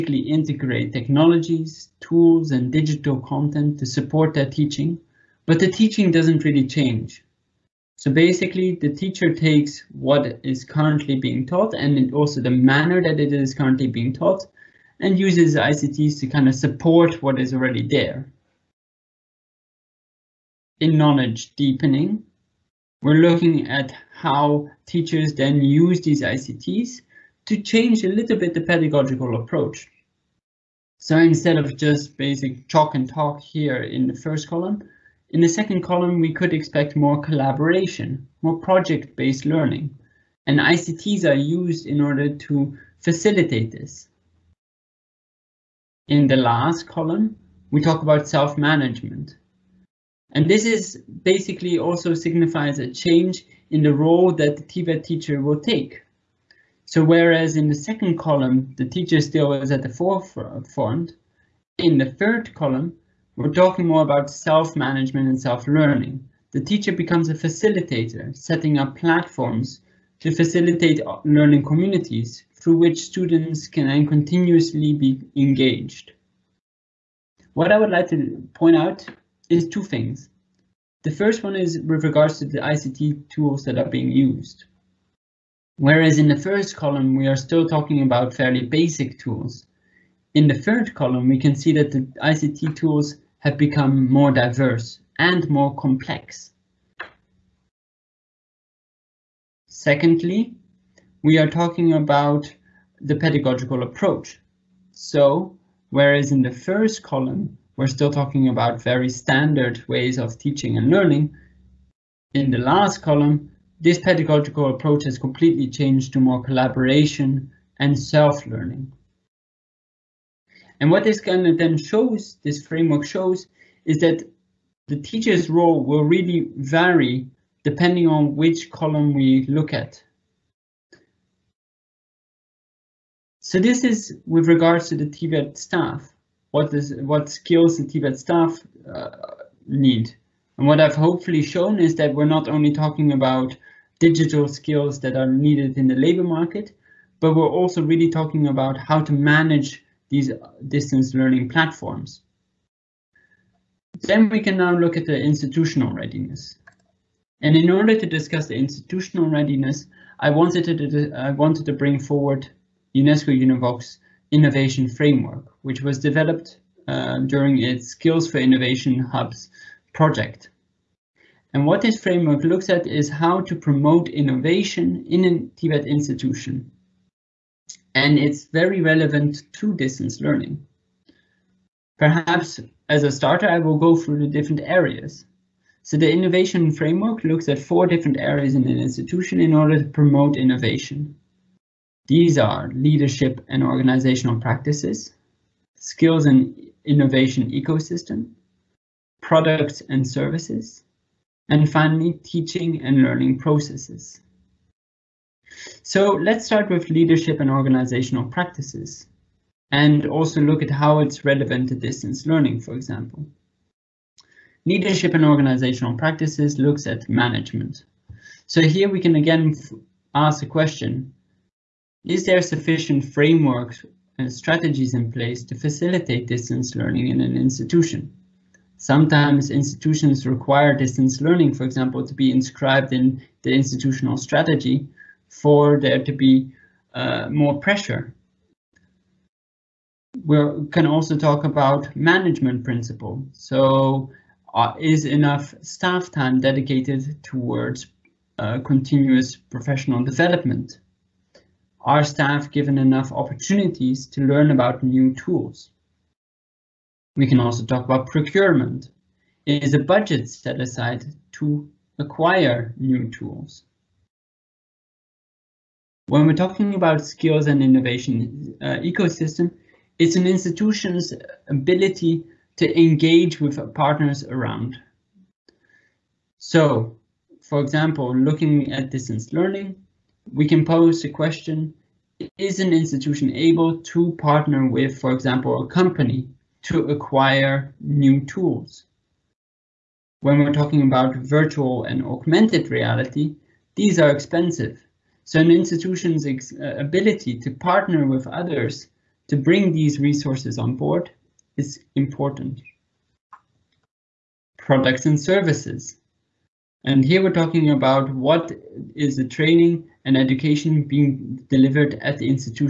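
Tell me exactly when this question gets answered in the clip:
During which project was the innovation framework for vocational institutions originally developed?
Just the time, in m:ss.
2:47.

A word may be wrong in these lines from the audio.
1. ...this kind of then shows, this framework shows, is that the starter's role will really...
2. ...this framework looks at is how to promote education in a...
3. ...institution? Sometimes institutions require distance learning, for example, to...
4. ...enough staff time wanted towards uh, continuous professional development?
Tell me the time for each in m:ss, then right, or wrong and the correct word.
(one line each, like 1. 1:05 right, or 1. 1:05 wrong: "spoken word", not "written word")
1. 2:01 wrong: "teacher", not "starter"
2. 2:51 wrong: "innovation", not "education"
3. 3:47 right
4. 4:05 wrong: "dedicated", not "wanted".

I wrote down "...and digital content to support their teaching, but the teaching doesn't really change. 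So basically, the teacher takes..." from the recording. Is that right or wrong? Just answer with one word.
right.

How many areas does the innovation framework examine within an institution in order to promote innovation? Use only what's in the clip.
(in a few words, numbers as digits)
4.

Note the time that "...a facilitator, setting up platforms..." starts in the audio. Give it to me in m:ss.
1:07.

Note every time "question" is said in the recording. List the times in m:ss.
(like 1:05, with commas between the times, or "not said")
3:40, 4:41.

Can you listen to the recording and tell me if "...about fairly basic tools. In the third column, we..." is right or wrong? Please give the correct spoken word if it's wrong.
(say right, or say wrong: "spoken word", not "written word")
right.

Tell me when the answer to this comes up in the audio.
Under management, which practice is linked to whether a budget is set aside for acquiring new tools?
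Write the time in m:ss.
4:18.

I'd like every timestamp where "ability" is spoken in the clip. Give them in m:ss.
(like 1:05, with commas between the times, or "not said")
4:31, 4:56.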